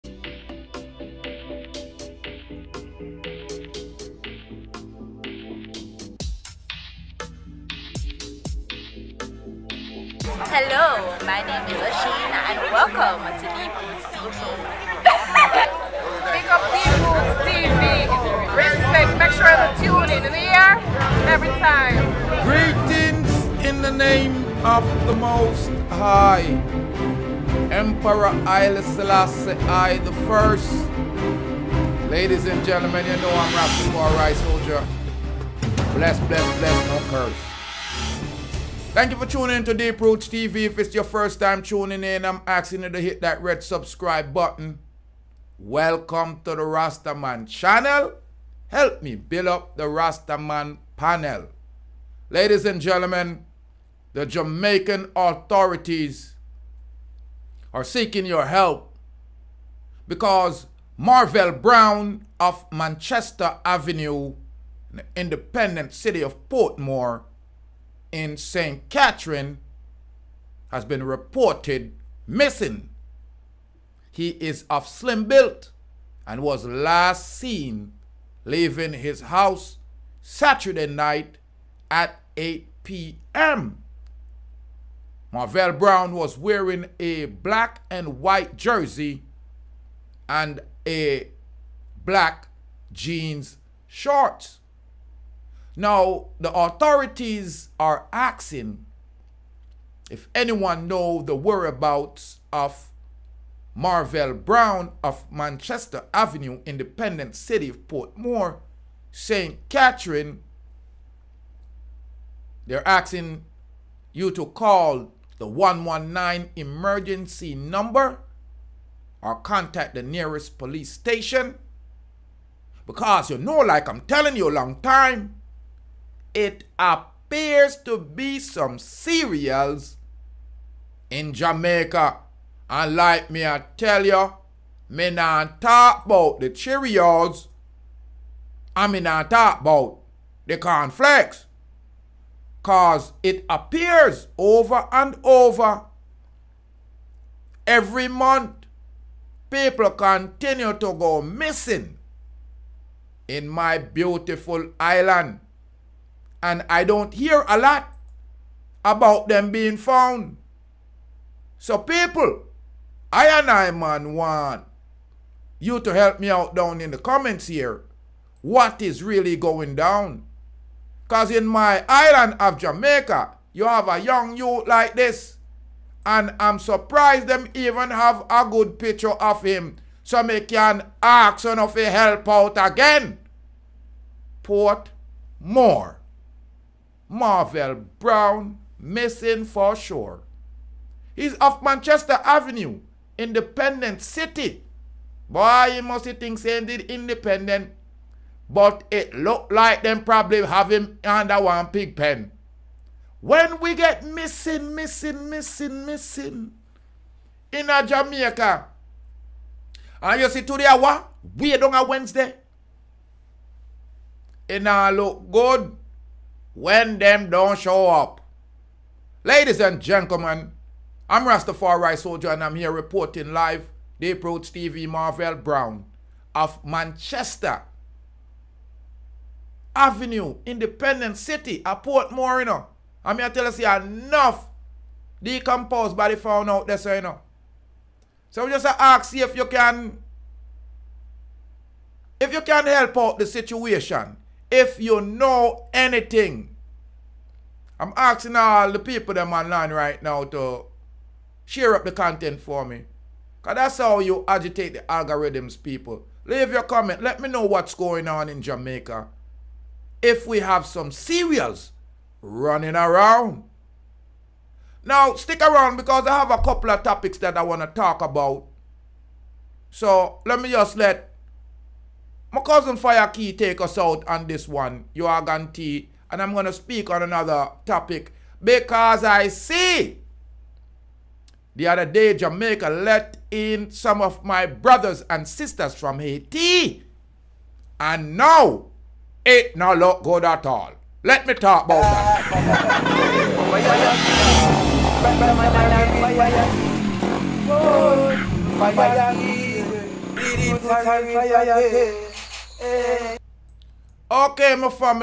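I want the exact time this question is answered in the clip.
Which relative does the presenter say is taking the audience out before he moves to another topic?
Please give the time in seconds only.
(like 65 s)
272 s.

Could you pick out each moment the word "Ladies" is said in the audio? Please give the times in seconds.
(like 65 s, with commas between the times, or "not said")
32 s, 52 s, 219 s.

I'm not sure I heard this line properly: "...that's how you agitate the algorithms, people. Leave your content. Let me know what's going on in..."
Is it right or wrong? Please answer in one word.
wrong.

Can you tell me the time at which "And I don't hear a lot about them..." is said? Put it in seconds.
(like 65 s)
156 s.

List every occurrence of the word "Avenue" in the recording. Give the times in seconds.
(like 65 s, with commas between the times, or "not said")
63 s, 106 s, 192 s, 229 s.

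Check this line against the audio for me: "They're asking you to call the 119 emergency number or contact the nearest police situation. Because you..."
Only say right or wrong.
wrong.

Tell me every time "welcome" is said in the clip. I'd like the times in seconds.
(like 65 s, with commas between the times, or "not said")
12 s, 45 s.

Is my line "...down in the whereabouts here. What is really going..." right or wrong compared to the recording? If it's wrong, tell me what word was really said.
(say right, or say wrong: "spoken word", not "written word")
wrong: "comments", not "whereabouts".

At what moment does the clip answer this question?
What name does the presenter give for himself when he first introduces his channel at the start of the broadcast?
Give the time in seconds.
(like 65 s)
11 s.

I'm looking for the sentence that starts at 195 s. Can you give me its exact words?
Boy, you must think saying did independent.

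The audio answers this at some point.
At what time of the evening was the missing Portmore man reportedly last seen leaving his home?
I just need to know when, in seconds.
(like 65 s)
82 s.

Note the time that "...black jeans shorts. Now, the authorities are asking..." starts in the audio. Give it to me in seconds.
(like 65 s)
92 s.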